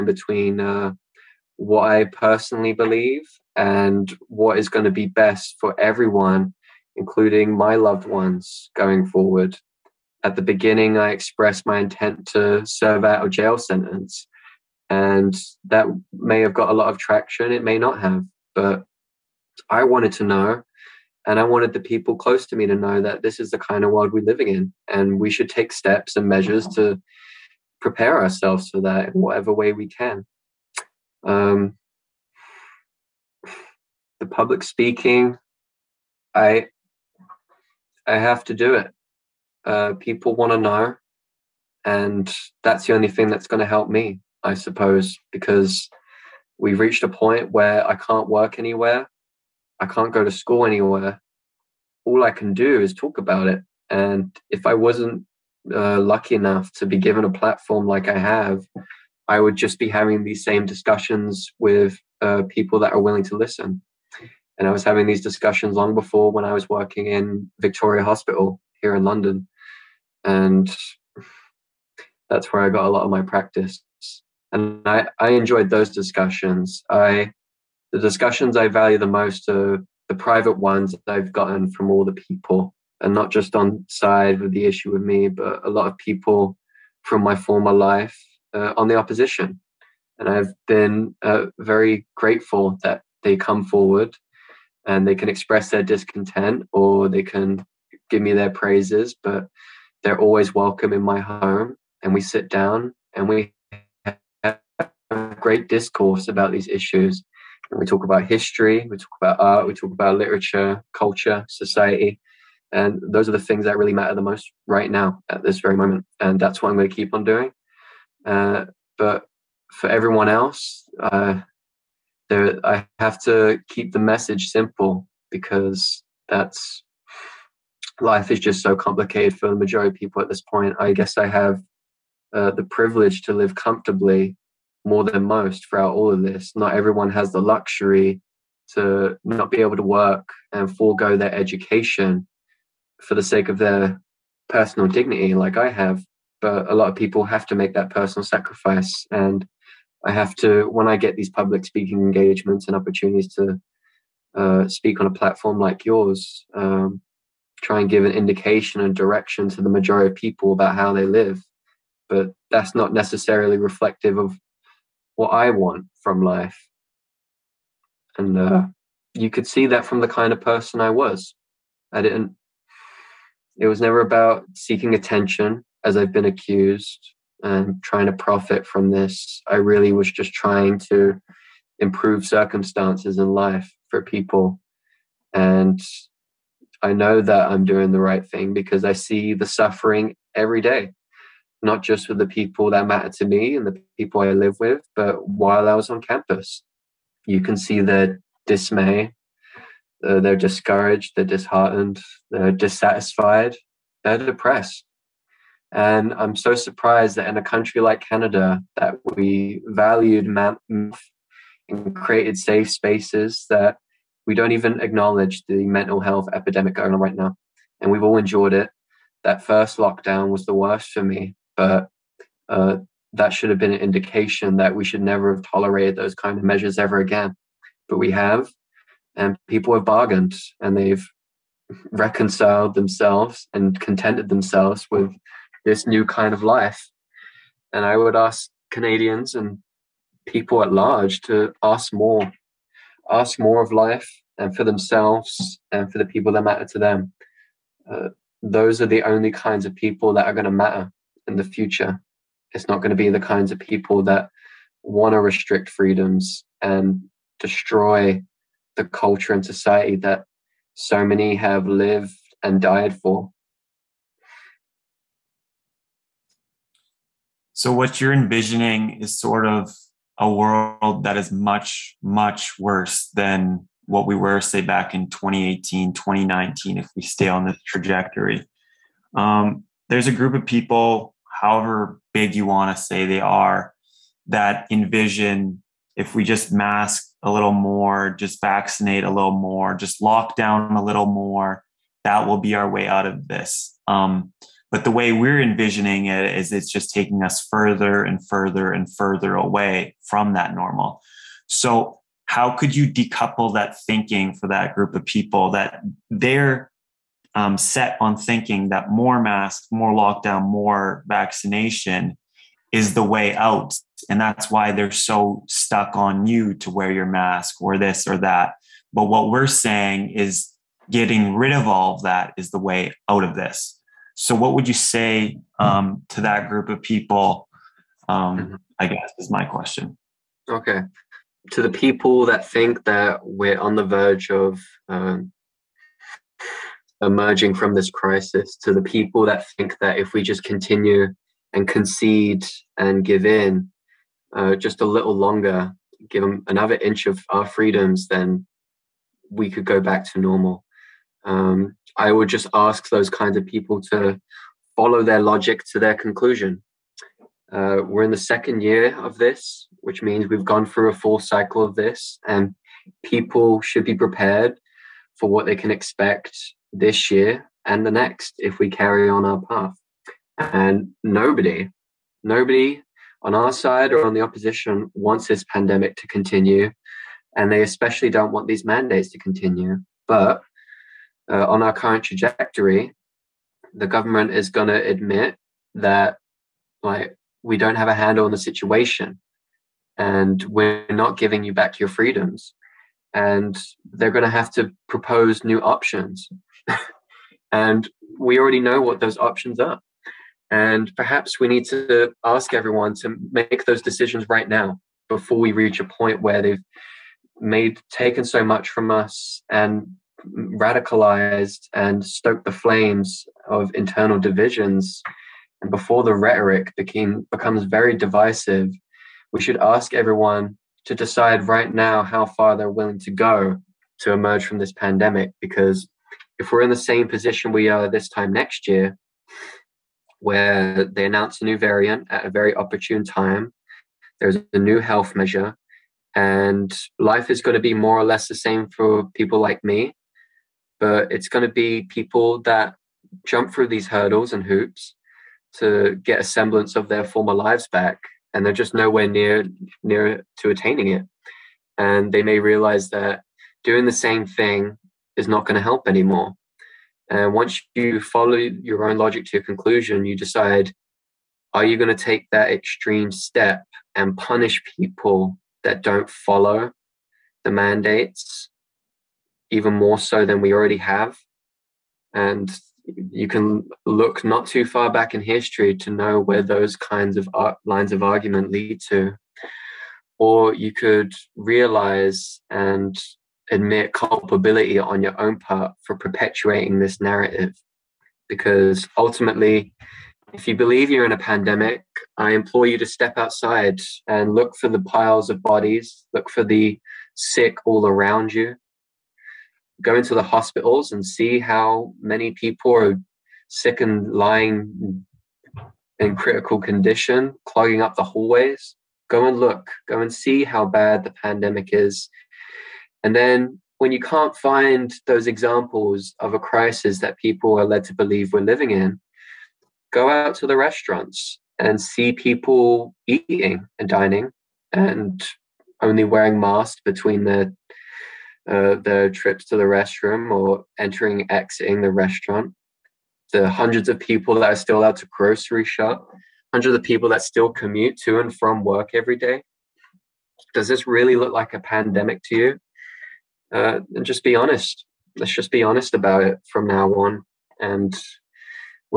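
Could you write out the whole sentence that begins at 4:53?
Um, but the way we're envisioning it is it's just taking us further and further and further away from that normal.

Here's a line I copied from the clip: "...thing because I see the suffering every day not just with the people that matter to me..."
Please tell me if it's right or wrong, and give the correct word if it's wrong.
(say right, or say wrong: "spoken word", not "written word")
right.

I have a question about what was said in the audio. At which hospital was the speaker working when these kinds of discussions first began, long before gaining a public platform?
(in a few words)
Victoria Hospital.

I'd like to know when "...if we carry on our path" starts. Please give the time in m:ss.
6:08.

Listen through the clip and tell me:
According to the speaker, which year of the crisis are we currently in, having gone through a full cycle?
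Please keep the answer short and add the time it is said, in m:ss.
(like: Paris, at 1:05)
second year, at 5:58.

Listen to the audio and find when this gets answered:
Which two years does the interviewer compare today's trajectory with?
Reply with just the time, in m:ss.
4:35.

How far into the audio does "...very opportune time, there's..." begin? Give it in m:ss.
7:12.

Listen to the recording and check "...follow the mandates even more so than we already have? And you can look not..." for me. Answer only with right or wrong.
right.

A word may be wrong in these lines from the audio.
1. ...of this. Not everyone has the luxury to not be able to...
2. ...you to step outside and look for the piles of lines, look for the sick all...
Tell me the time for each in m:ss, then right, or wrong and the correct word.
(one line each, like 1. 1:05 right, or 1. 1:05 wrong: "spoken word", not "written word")
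1. 2:16 right
2. 8:12 wrong: "bodies", not "lines".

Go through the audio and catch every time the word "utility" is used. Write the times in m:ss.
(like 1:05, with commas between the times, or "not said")
not said.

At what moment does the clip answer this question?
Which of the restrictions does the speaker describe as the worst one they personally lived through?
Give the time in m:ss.
3:39.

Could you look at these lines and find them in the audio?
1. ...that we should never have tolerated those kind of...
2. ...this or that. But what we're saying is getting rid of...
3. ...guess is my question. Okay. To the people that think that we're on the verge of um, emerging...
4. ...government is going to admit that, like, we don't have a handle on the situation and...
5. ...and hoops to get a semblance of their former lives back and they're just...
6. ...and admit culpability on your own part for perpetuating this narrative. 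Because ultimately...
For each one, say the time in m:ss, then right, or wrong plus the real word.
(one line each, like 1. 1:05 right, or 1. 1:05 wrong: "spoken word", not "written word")
1. 3:44 right
2. 5:17 right
3. 5:28 right
4. 6:23 right
5. 7:24 right
6. 8:02 right.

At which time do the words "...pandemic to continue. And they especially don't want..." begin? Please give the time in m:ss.
6:15.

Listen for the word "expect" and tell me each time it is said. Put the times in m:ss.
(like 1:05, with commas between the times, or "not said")
6:05.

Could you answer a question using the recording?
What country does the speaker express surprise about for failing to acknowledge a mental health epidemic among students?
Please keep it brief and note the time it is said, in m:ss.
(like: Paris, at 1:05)
Canada, at 3:28.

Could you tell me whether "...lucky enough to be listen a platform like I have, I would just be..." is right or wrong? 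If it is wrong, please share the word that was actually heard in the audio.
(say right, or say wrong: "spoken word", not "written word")
wrong: "given", not "listen".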